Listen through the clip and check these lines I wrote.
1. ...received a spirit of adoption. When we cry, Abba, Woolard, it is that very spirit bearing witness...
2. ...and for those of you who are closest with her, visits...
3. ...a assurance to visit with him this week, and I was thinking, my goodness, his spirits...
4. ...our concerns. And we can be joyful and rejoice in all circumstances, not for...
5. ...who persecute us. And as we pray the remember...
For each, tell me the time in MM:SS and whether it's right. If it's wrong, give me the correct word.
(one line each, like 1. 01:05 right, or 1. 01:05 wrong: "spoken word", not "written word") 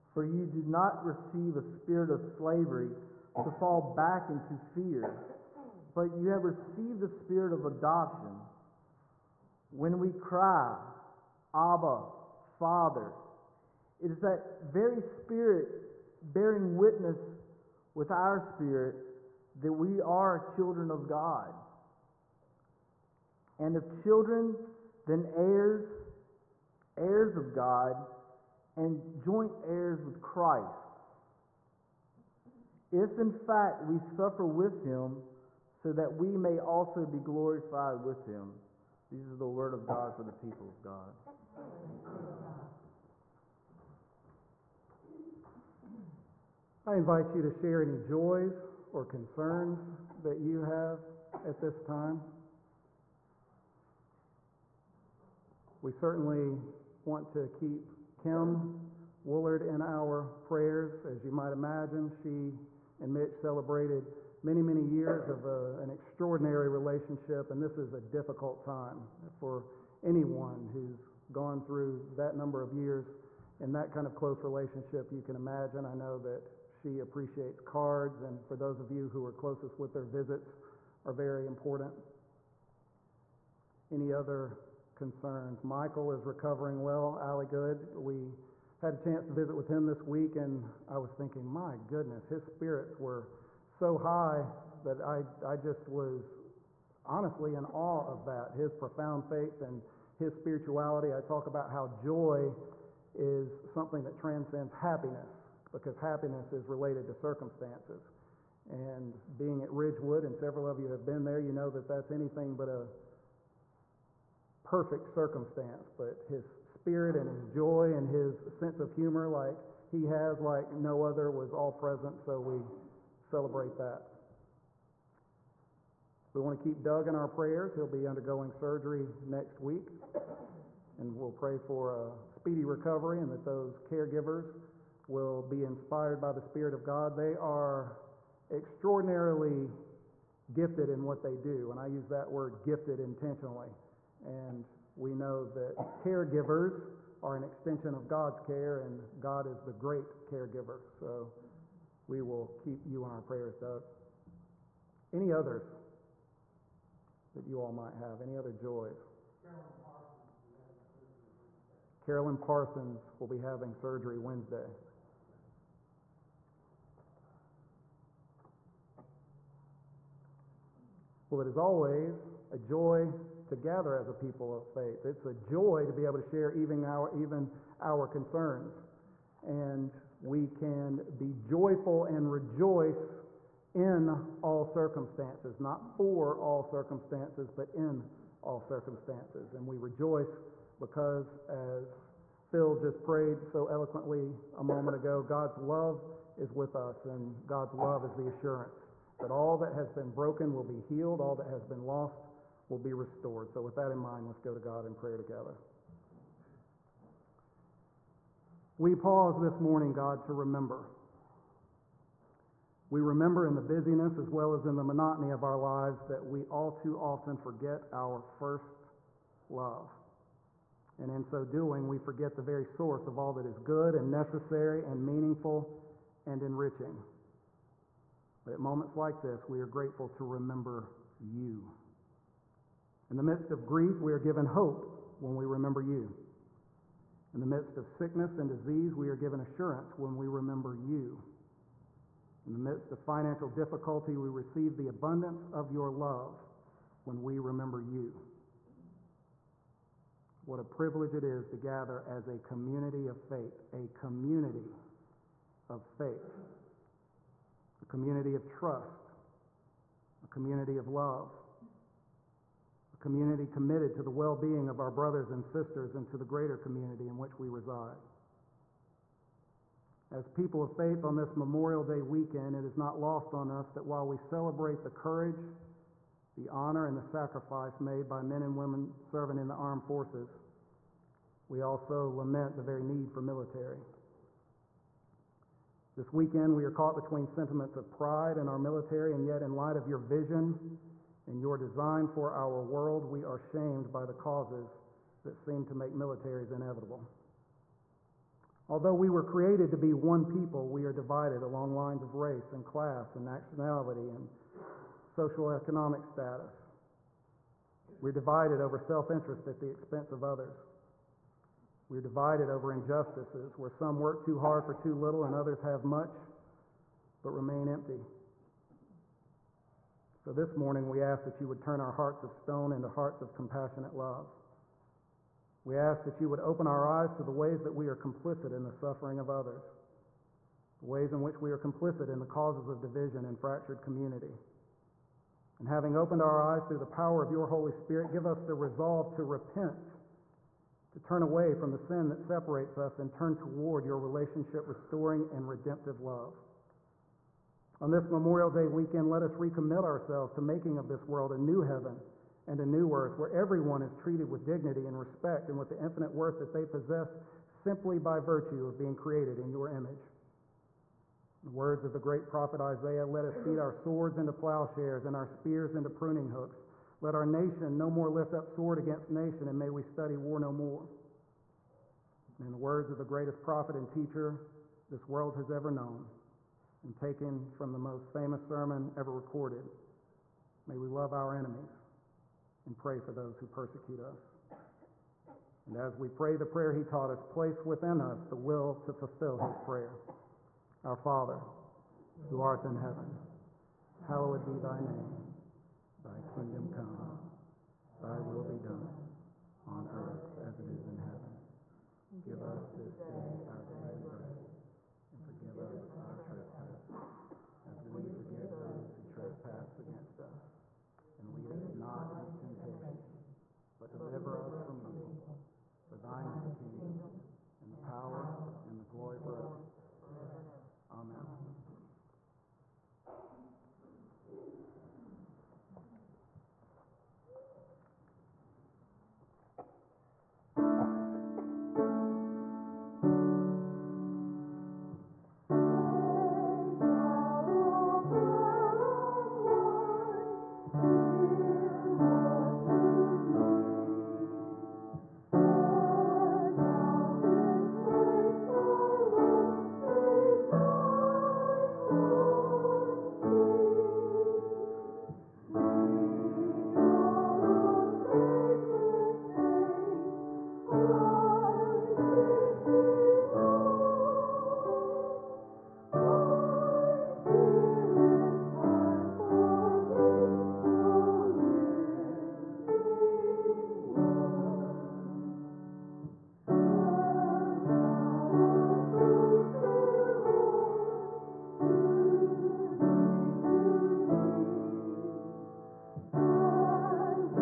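1. 00:06 wrong: "Father", not "Woolard"
2. 01:18 right
3. 01:28 wrong: "chance", not "assurance"
4. 02:57 right
5. 06:23 wrong: "prayer", not "remember".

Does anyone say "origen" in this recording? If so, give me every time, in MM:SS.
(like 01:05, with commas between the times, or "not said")
not said.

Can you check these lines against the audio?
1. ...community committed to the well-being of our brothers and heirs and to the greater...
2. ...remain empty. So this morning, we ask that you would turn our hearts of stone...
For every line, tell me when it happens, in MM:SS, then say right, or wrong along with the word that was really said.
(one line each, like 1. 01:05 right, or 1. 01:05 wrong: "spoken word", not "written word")
1. 04:22 wrong: "sisters", not "heirs"
2. 05:17 right.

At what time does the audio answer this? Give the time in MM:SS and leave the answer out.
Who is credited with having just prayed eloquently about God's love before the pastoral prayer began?
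03:12.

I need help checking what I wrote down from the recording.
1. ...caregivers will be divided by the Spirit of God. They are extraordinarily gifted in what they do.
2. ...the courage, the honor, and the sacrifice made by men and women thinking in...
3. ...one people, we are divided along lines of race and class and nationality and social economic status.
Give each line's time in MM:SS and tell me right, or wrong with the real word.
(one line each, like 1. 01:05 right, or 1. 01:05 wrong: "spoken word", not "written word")
1. 02:13 wrong: "inspired", not "divided"
2. 04:34 wrong: "serving", not "thinking"
3. 04:59 right.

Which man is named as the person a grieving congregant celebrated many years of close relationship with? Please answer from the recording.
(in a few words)
Mitch.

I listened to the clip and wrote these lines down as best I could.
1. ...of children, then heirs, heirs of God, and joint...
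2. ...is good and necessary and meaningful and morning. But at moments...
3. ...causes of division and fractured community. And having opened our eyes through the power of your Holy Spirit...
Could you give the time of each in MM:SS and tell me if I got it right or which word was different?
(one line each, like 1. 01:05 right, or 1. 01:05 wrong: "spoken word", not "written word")
1. 00:23 right
2. 03:43 wrong: "enriching", not "morning"
3. 05:32 right.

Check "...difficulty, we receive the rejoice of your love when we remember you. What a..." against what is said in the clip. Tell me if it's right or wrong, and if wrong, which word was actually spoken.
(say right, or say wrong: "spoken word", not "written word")
wrong: "abundance", not "rejoice".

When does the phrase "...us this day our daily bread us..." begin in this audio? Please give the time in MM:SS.
06:42.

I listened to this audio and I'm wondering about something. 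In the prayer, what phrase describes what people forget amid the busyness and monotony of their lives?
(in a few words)
first love.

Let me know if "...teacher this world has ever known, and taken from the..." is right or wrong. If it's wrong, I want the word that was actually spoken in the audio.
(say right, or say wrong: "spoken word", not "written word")
right.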